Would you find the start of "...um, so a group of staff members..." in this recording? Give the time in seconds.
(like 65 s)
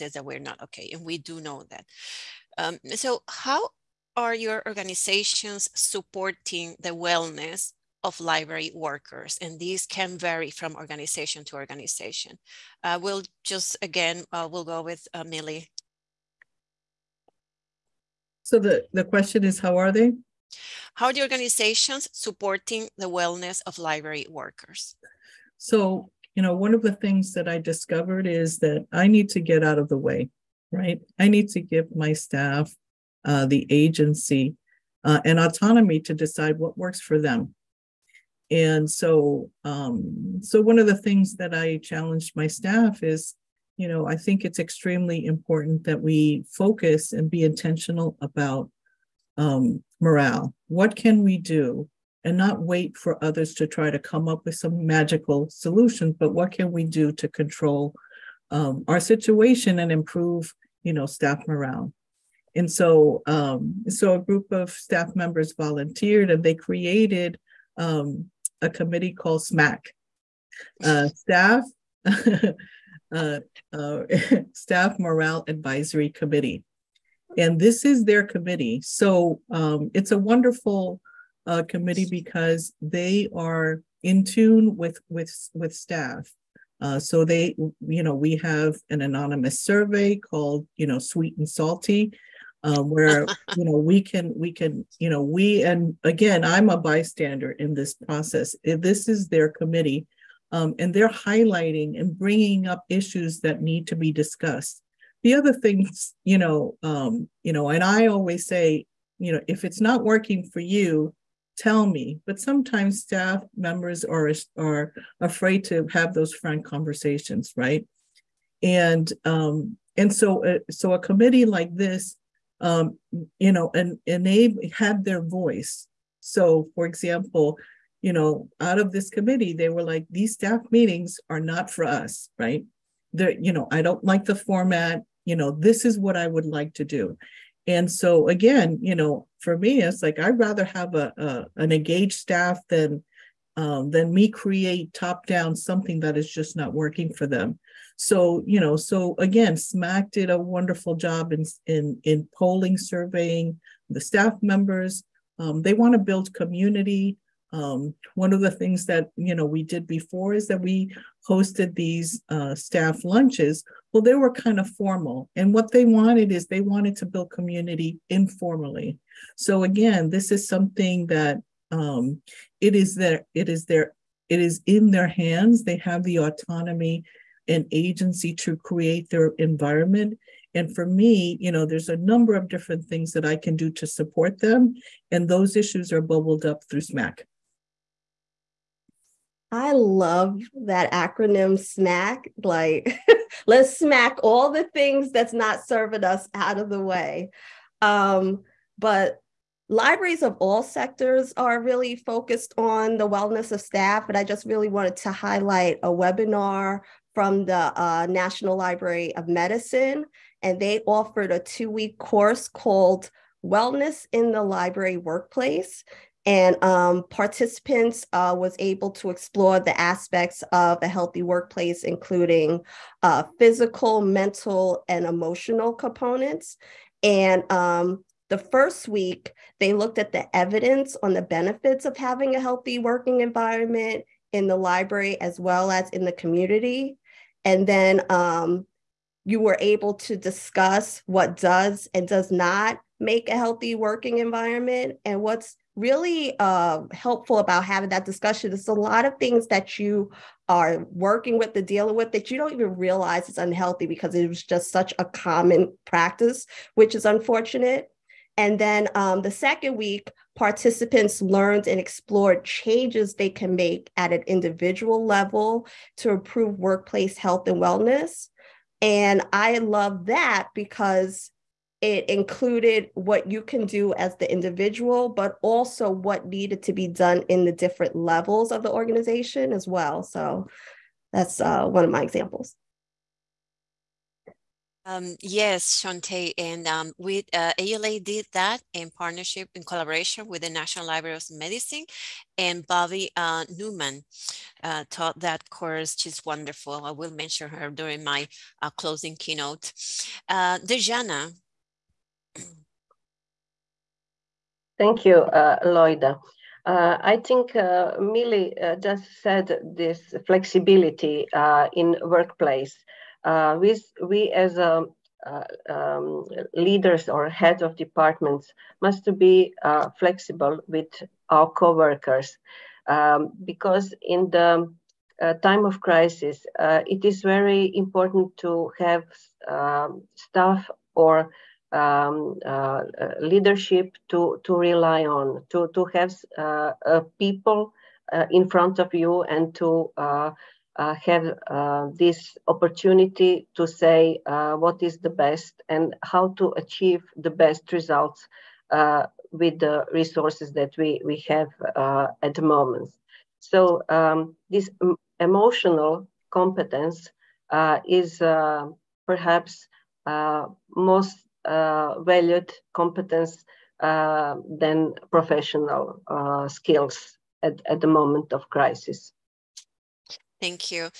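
63 s.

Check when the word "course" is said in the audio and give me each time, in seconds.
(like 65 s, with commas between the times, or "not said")
211 s, 295 s.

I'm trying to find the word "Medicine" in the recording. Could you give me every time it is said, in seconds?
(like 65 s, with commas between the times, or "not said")
209 s, 291 s.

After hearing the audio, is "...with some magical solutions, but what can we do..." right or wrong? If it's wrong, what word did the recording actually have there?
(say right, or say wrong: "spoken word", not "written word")
right.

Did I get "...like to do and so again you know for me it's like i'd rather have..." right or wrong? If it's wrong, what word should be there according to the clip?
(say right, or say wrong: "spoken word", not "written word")
right.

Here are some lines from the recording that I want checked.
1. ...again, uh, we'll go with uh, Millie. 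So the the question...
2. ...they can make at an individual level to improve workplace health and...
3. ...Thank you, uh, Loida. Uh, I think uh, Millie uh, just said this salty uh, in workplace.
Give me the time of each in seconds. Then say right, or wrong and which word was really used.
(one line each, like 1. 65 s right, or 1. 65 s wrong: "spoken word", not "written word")
1. 13 s right
2. 263 s right
3. 304 s wrong: "flexibility", not "salty".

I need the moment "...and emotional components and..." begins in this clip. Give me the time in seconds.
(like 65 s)
224 s.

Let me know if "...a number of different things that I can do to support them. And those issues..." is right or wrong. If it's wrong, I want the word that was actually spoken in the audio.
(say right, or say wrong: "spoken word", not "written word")
right.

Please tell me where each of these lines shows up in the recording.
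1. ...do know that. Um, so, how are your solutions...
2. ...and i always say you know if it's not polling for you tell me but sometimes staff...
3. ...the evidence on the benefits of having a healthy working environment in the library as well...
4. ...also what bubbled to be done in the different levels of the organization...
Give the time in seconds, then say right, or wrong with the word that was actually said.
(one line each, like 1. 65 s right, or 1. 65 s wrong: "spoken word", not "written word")
1. 1 s wrong: "organizations", not "solutions"
2. 107 s wrong: "working", not "polling"
3. 230 s right
4. 275 s wrong: "needed", not "bubbled".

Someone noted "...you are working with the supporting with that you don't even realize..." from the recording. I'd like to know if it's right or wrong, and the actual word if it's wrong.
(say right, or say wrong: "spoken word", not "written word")
wrong: "dealing", not "supporting".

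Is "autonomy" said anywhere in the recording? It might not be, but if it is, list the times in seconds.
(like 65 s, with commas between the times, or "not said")
35 s, 176 s.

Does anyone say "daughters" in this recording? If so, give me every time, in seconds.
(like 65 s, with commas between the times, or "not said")
not said.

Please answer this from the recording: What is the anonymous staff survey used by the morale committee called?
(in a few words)
Sweet and salty.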